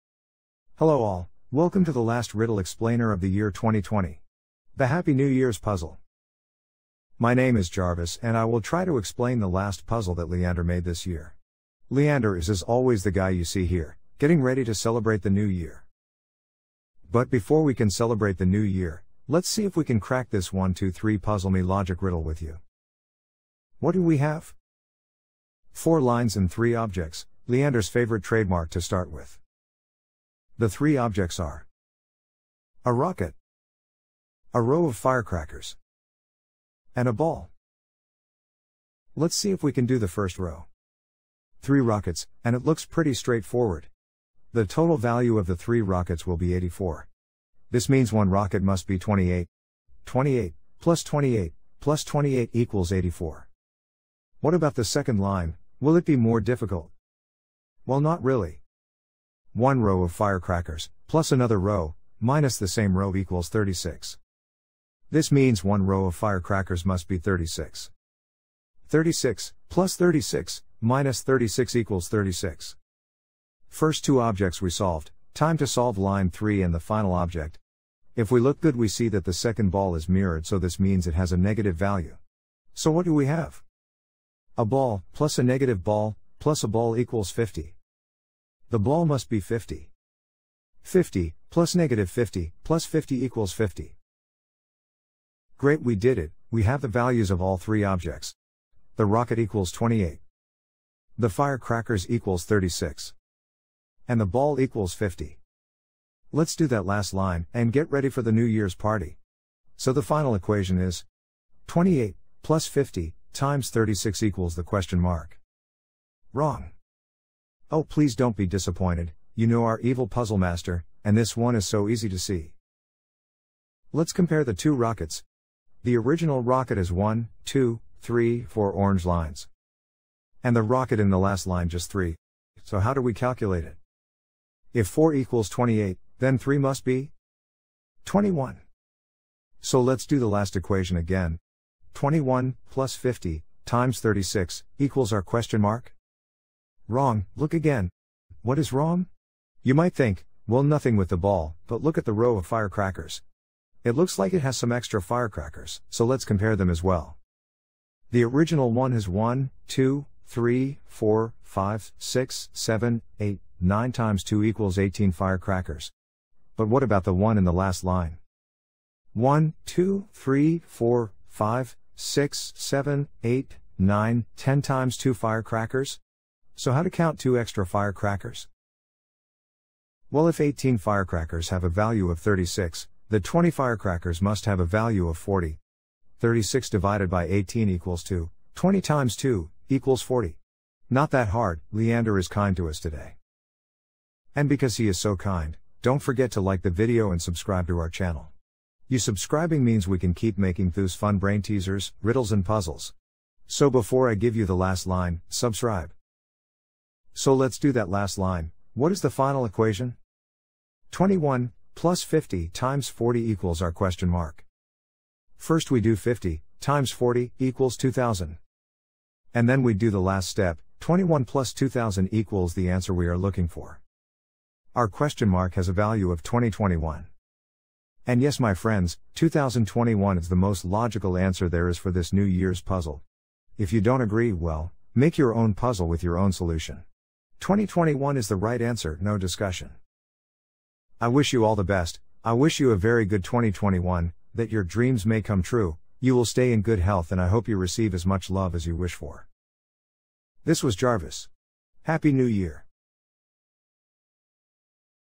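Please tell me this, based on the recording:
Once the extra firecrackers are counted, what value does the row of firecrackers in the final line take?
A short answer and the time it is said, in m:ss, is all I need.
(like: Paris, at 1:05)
40, at 3:03.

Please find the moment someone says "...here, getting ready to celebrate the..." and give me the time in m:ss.
0:13.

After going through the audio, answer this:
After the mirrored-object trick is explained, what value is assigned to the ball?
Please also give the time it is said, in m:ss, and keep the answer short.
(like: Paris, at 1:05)
50, at 1:28.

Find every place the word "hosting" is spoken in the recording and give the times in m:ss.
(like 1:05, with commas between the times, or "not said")
not said.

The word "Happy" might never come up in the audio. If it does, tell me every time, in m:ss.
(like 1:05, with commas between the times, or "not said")
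0:04, 4:11.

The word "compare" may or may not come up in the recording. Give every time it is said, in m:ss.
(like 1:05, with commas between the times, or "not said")
2:04, 2:36.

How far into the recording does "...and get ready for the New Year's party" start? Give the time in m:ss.
1:47.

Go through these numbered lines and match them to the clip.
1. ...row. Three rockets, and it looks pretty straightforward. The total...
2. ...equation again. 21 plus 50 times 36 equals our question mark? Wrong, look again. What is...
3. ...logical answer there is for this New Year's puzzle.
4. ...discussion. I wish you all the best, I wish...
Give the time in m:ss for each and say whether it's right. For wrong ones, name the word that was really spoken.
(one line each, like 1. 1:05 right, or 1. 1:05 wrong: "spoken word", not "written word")
1. 0:40 right
2. 2:20 right
3. 3:50 right
4. 3:59 right.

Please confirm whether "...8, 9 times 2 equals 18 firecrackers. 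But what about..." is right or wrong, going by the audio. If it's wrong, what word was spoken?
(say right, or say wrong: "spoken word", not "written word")
right.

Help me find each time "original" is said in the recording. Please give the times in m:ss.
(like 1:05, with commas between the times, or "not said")
2:05, 2:38.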